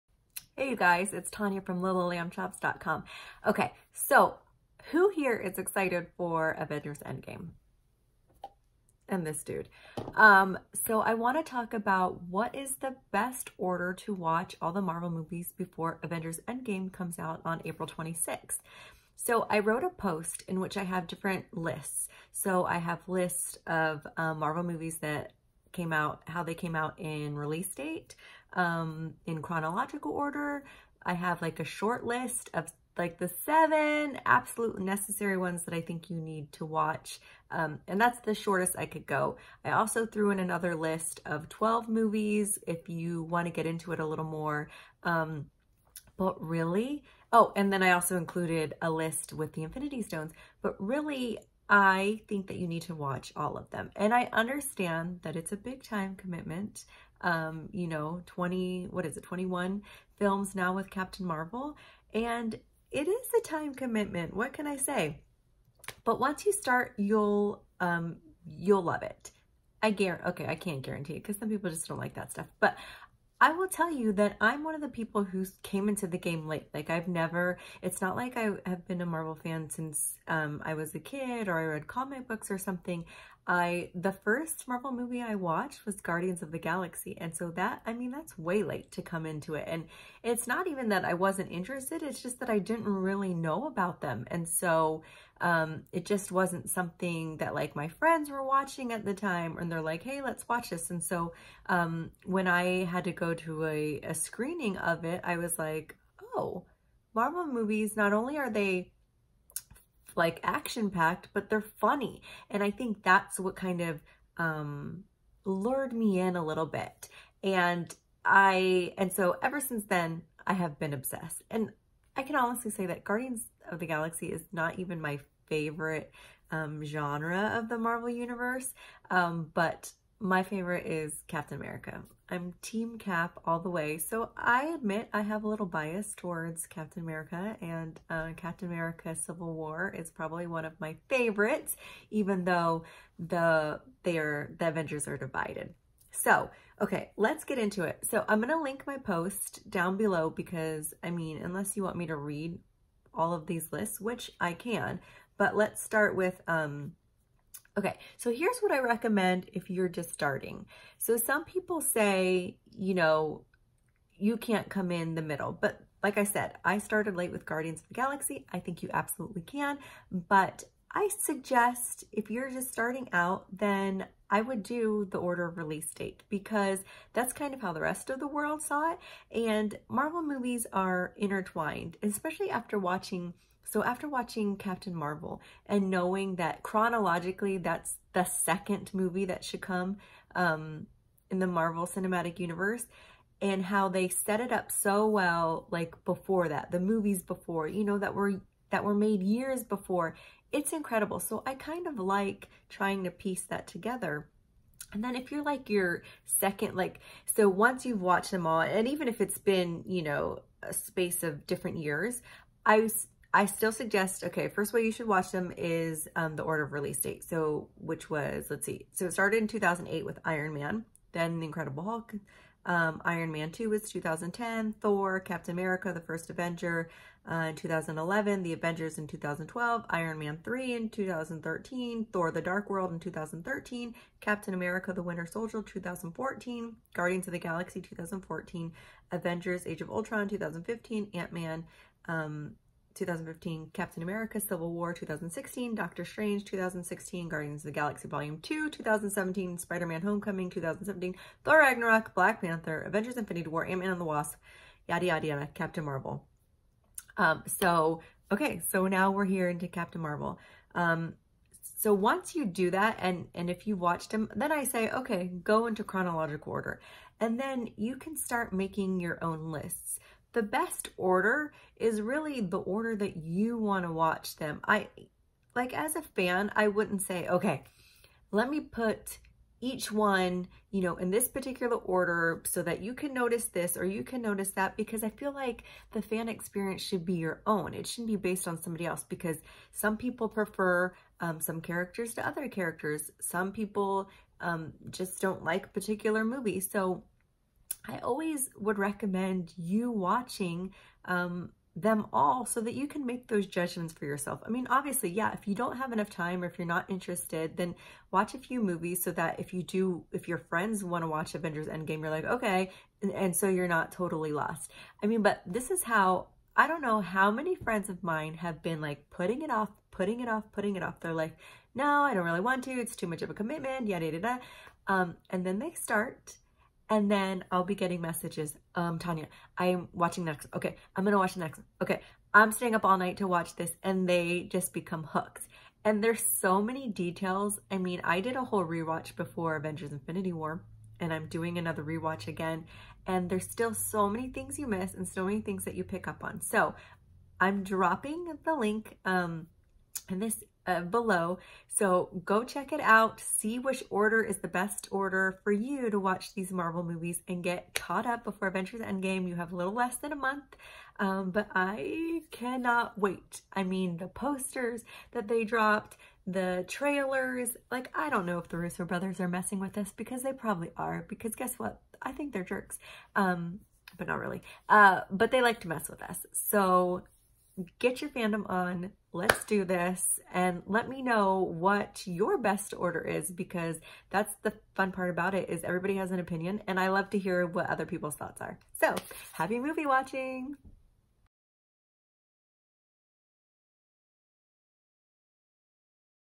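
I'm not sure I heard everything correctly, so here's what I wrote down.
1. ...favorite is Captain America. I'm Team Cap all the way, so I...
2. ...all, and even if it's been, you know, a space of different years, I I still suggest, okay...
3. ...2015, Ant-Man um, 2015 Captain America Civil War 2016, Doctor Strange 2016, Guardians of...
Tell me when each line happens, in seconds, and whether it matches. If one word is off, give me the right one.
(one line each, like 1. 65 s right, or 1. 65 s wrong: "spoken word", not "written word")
1. 130 s right
2. 208 s right
3. 240 s right.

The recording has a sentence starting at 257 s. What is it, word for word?
Um, so, okay, so now we're here into Captain Marvel.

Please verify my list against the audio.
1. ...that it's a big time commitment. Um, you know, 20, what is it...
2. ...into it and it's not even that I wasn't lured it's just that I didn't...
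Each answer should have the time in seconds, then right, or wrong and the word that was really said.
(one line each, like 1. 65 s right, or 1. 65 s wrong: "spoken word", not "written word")
1. 55 s right
2. 89 s wrong: "interested", not "lured".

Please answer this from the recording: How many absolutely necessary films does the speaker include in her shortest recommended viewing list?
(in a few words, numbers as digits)
7.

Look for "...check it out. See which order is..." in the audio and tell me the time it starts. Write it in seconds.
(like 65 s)
352 s.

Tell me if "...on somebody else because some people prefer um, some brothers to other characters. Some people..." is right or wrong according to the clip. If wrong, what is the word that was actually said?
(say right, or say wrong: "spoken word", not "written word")
wrong: "characters", not "brothers".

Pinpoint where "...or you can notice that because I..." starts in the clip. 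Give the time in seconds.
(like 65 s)
283 s.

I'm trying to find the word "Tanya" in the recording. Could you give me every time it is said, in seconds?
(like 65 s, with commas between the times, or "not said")
1 s, 328 s.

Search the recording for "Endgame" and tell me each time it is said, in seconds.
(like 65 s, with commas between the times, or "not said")
7 s, 16 s, 311 s, 358 s.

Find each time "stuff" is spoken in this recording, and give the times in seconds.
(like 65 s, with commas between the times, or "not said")
72 s.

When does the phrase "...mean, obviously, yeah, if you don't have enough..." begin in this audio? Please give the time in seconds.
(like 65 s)
304 s.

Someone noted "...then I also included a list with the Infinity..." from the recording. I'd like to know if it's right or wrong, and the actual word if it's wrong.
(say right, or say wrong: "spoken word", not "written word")
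right.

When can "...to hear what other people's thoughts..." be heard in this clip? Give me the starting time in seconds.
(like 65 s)
387 s.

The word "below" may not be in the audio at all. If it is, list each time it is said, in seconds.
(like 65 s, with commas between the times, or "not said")
149 s, 350 s.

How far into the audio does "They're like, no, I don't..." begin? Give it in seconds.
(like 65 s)
320 s.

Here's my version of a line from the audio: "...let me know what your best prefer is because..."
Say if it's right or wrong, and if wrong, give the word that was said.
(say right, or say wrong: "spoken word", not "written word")
wrong: "order", not "prefer".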